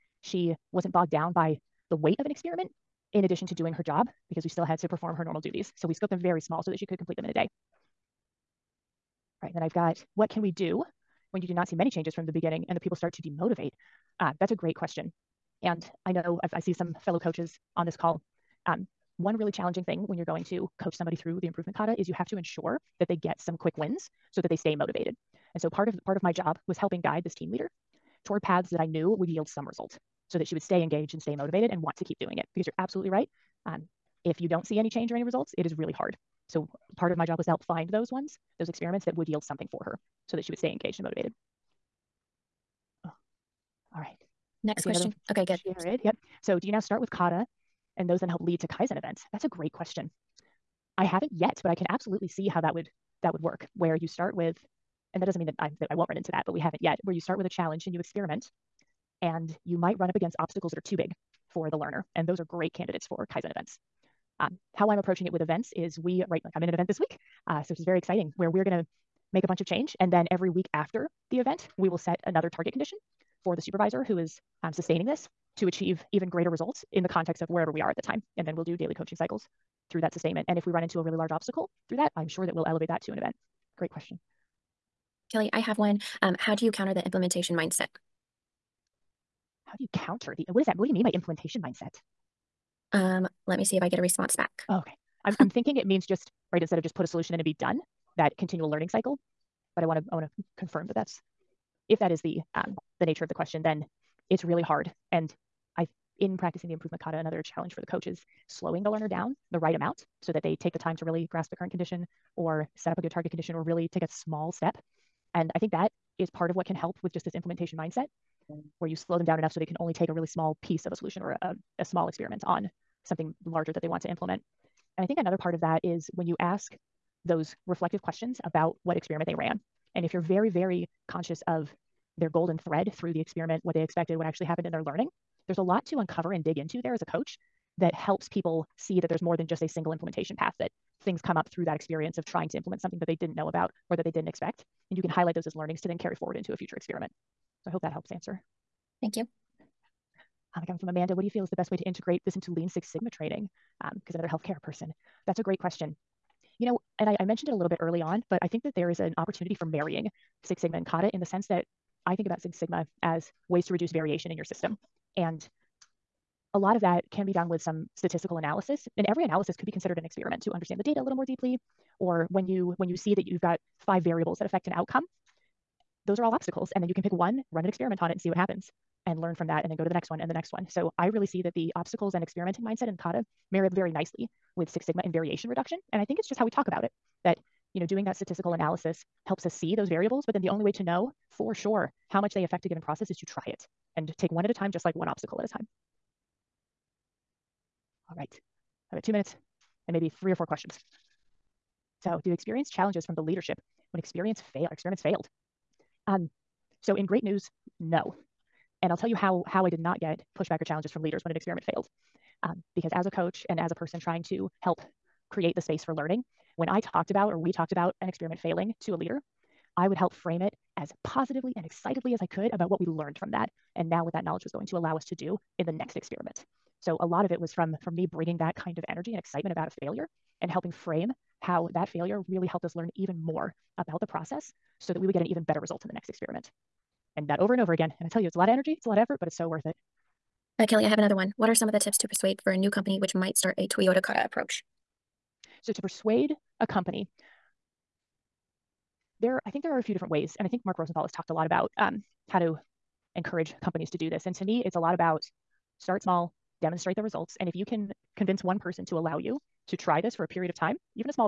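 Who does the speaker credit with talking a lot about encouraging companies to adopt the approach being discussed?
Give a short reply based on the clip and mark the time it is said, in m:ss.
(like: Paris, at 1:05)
Mark Rosenthal, at 4:10.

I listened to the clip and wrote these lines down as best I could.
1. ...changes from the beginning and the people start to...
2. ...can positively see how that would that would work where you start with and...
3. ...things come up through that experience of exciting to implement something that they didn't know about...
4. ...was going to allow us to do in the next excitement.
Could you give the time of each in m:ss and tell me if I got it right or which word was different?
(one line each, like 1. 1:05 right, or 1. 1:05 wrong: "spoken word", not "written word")
1. 0:11 right
2. 0:51 wrong: "absolutely", not "positively"
3. 2:21 wrong: "trying", not "exciting"
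4. 3:44 wrong: "experiment", not "excitement".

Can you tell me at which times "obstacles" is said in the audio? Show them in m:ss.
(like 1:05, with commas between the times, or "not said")
1:00, 1:21, 2:56, 3:01, 3:15.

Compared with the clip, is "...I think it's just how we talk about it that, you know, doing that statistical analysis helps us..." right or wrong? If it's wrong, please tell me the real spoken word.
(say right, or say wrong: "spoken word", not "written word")
right.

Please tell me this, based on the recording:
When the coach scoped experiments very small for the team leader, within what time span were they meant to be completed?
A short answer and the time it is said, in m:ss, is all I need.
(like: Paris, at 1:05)
a day, at 0:07.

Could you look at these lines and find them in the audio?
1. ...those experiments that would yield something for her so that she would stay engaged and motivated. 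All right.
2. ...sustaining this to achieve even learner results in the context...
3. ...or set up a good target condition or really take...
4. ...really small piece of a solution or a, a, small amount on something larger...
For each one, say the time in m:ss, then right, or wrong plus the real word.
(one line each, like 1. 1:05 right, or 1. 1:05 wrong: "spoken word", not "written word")
1. 0:38 right
2. 1:14 wrong: "greater", not "learner"
3. 1:52 right
4. 2:00 wrong: "experiment", not "amount".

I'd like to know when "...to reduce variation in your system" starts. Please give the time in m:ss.
2:43.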